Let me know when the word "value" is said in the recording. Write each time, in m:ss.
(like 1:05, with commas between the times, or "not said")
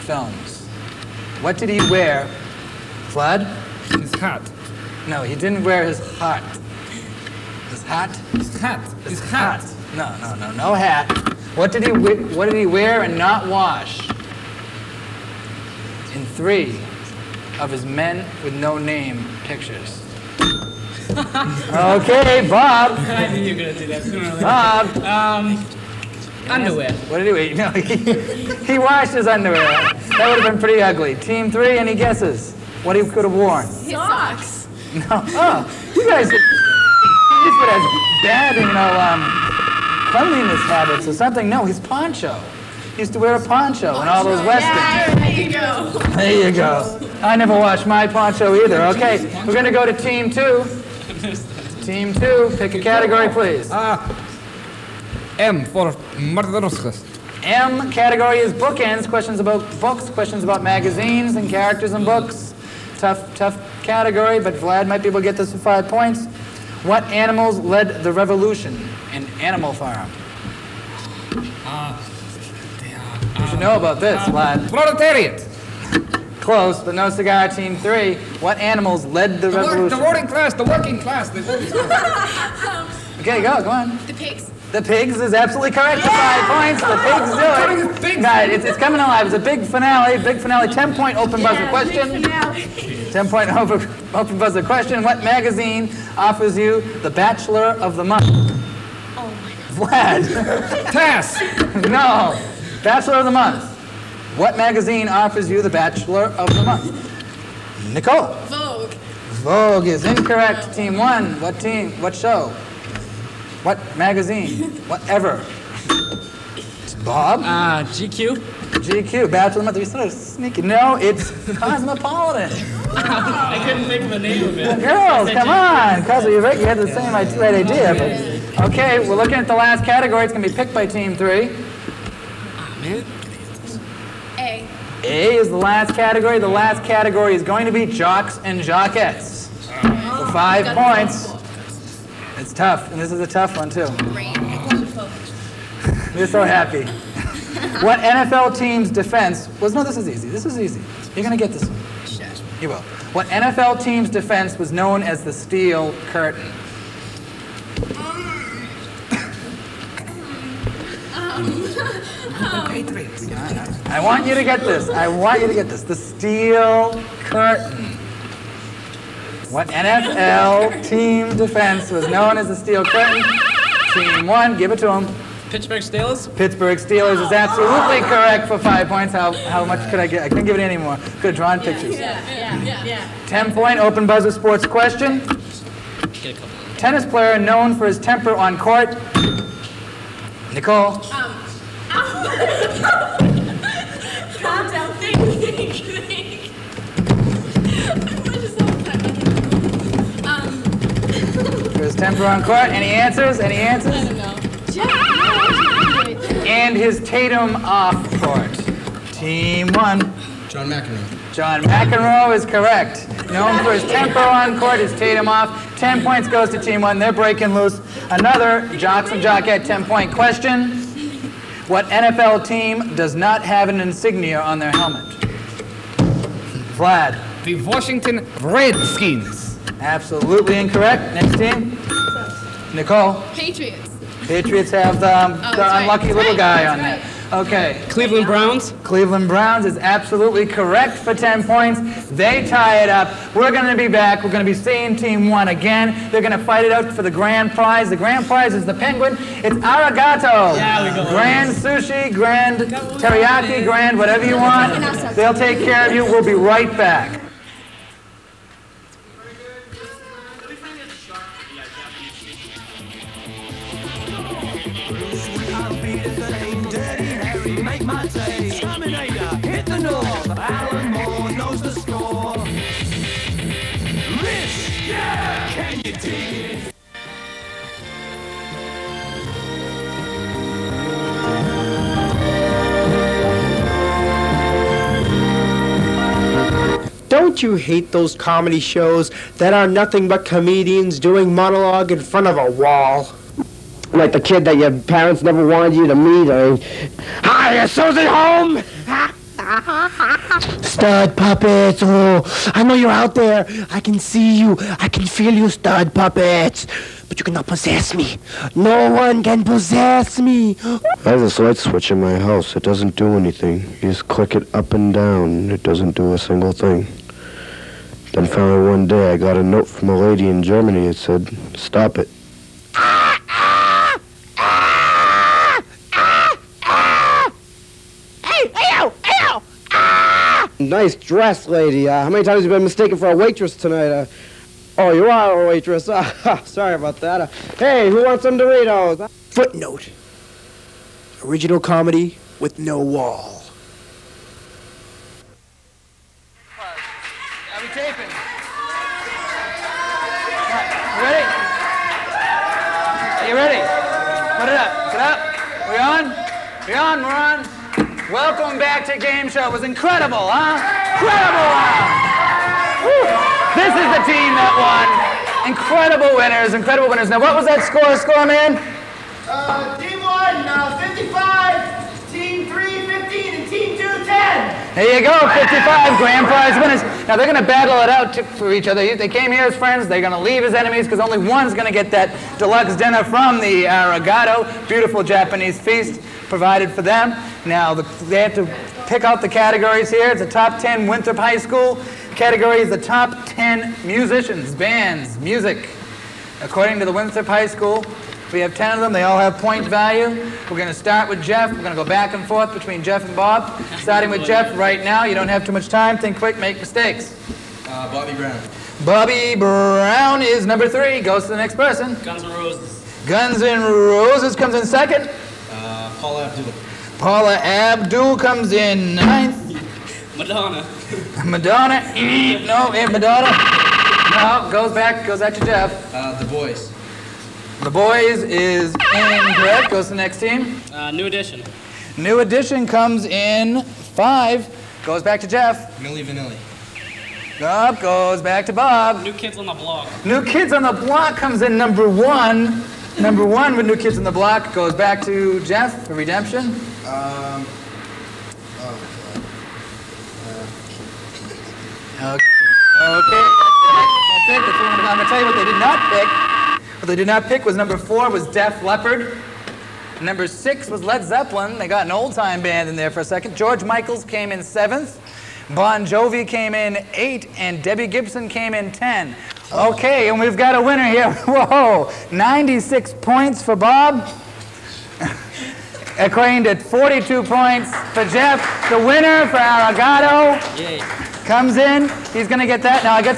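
6:39.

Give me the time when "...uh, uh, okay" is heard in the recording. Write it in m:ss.
7:31.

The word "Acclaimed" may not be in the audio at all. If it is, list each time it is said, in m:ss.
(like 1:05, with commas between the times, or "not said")
7:55.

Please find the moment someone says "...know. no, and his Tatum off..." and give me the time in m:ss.
3:24.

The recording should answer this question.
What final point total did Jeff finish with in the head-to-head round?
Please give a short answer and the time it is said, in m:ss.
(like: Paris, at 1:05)
42, at 7:56.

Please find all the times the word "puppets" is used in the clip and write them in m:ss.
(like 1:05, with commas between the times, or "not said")
5:01, 5:05.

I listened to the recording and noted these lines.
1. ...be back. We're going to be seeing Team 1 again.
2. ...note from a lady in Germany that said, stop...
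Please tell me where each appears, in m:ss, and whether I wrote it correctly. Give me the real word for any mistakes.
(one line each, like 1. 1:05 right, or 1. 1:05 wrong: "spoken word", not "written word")
1. 4:03 right
2. 5:19 right.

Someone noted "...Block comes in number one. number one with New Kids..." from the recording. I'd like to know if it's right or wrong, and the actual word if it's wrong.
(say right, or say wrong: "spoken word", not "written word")
right.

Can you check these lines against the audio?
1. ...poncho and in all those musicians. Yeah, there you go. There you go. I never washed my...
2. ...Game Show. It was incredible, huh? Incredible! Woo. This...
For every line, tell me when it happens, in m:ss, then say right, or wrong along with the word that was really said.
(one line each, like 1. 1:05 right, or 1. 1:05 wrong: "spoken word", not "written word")
1. 0:43 wrong: "westerns", not "musicians"
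2. 5:58 right.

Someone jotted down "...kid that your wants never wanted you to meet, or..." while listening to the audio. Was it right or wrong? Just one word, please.
wrong.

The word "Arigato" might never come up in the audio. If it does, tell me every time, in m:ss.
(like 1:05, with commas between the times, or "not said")
4:09, 6:23, 7:59.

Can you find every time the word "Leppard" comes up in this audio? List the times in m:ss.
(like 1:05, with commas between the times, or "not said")
7:38.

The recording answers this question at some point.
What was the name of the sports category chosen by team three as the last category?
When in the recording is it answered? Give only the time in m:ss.
2:17.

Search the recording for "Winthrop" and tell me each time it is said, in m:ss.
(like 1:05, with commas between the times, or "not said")
6:30, 6:36.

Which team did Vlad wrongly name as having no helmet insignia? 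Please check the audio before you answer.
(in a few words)
Washington Redskins.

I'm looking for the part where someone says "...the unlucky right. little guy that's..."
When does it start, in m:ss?
3:55.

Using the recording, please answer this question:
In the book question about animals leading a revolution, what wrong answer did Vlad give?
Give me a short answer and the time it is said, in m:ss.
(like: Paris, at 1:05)
Proletariat, at 1:14.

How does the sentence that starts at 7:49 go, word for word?
Okay, and we've got a winner here.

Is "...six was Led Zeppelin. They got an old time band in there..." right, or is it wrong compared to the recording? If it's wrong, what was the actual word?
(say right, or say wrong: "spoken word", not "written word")
right.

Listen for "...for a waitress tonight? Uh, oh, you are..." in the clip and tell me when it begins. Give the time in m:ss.
5:32.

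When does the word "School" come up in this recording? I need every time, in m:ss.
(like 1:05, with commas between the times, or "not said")
6:31, 6:37.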